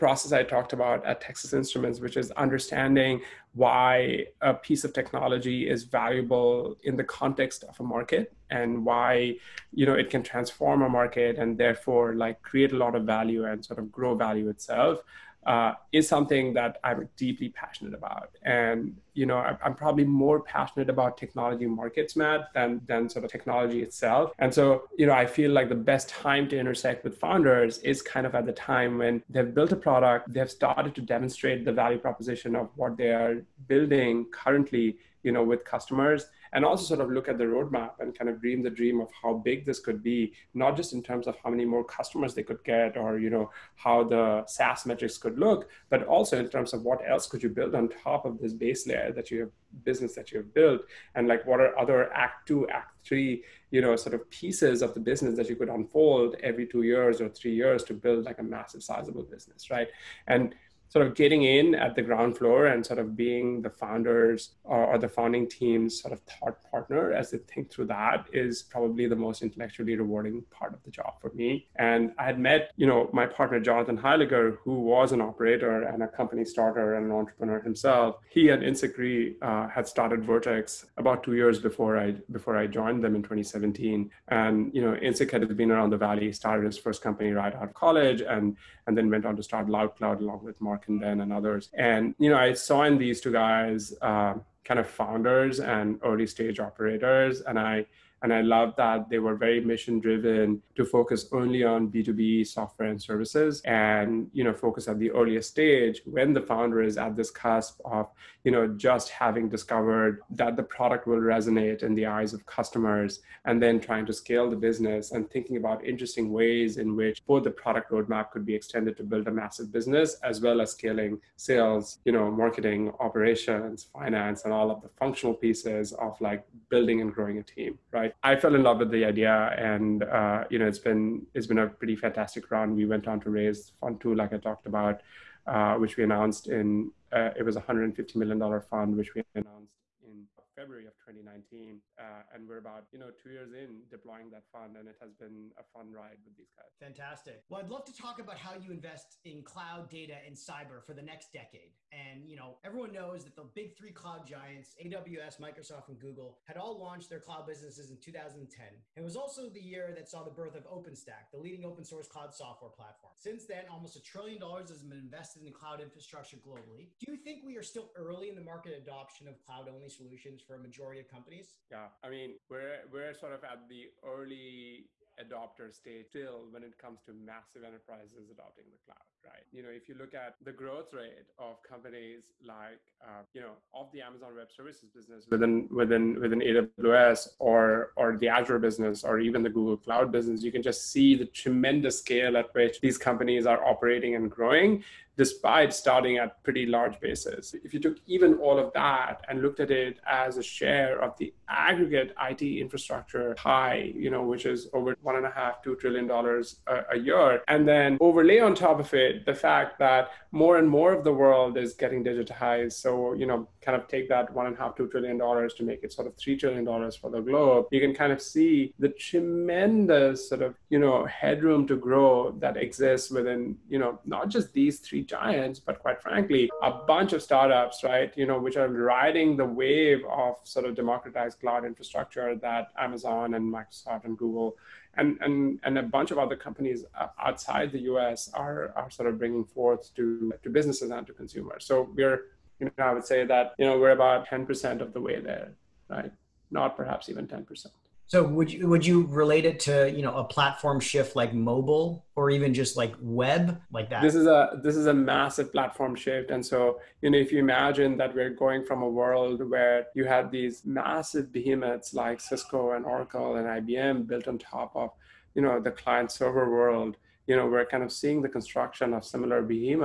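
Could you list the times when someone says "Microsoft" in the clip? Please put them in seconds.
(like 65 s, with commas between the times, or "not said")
155 s, 233 s.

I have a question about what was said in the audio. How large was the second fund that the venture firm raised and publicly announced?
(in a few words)
$150 million.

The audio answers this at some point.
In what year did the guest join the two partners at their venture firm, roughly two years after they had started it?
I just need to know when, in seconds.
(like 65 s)
83 s.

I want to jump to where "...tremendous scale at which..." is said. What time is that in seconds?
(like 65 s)
191 s.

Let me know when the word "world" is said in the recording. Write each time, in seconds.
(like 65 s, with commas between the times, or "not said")
211 s, 258 s, 266 s.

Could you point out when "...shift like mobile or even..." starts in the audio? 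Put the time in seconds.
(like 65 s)
250 s.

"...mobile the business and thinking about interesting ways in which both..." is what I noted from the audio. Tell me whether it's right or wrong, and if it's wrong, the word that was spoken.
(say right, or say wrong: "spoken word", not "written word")
wrong: "scale", not "mobile".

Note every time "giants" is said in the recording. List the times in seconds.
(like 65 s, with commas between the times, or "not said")
154 s, 225 s.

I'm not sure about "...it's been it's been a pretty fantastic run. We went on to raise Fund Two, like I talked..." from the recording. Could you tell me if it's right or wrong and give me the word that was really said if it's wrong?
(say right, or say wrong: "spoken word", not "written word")
right.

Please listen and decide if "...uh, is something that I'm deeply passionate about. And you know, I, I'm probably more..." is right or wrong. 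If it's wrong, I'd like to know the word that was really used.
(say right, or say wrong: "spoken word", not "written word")
right.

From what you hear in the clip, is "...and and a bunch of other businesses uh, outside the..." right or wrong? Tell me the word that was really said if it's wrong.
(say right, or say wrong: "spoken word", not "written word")
wrong: "companies", not "businesses".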